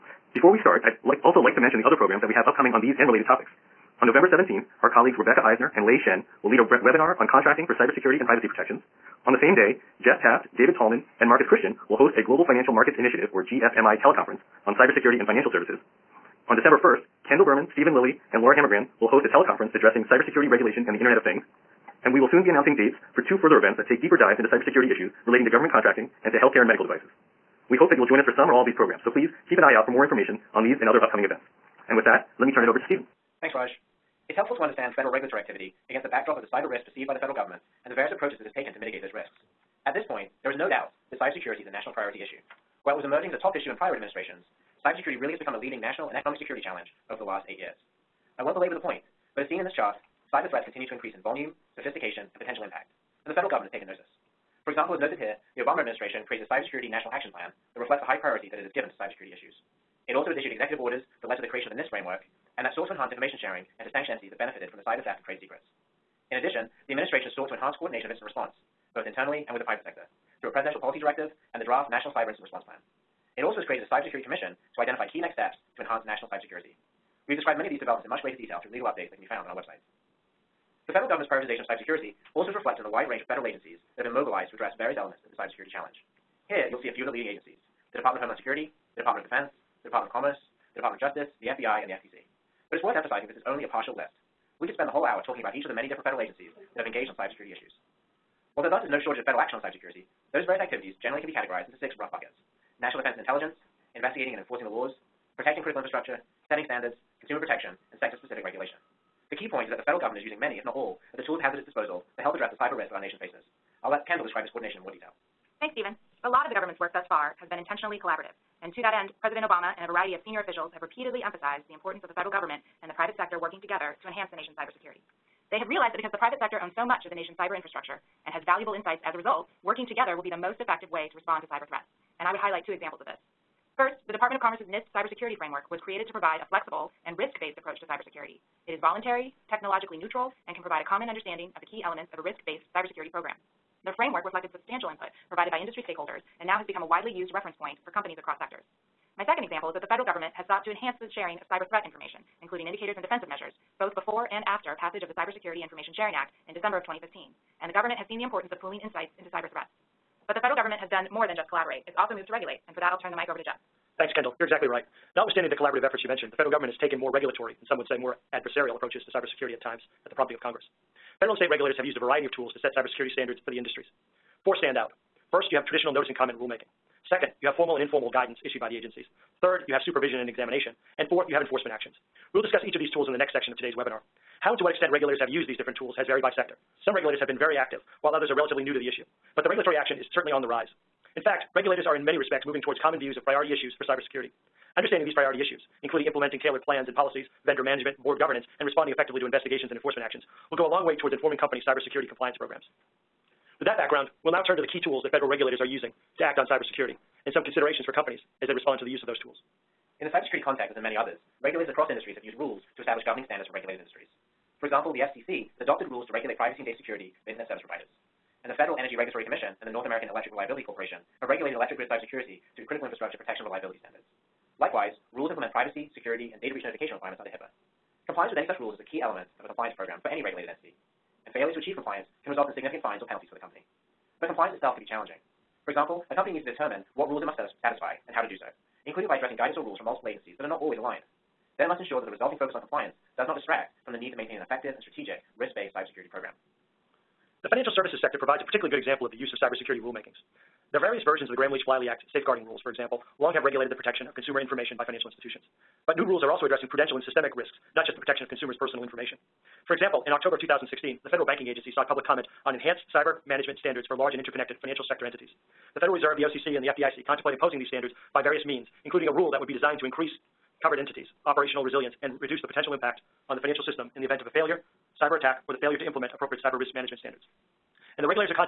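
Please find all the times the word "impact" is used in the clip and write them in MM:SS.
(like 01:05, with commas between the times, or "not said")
00:52, 04:32.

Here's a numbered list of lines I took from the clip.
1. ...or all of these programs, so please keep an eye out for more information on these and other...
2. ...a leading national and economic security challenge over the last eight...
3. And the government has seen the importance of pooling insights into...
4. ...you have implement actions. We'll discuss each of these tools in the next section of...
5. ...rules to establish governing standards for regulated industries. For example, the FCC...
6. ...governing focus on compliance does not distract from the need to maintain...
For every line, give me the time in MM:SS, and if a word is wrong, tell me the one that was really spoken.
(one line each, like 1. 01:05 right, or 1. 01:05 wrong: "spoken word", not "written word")
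1. 00:28 right
2. 00:45 right
3. 02:37 right
4. 03:01 wrong: "enforcement", not "implement"
5. 03:32 right
6. 04:02 wrong: "resulting", not "governing".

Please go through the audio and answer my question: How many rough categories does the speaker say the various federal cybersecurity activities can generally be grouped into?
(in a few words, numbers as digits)
6.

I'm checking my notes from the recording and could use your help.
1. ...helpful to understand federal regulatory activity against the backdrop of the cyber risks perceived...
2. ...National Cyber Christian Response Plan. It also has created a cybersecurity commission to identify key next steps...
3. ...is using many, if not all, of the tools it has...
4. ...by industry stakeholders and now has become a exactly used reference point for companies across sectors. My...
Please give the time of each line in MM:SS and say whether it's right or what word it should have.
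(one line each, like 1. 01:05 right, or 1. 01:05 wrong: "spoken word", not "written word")
1. 00:34 right
2. 01:11 wrong: "Incident", not "Christian"
3. 01:50 right
4. 02:25 wrong: "widely", not "exactly".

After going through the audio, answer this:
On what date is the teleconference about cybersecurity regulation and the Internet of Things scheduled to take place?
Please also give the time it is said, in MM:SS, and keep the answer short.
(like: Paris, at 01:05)
December 1st, at 00:16.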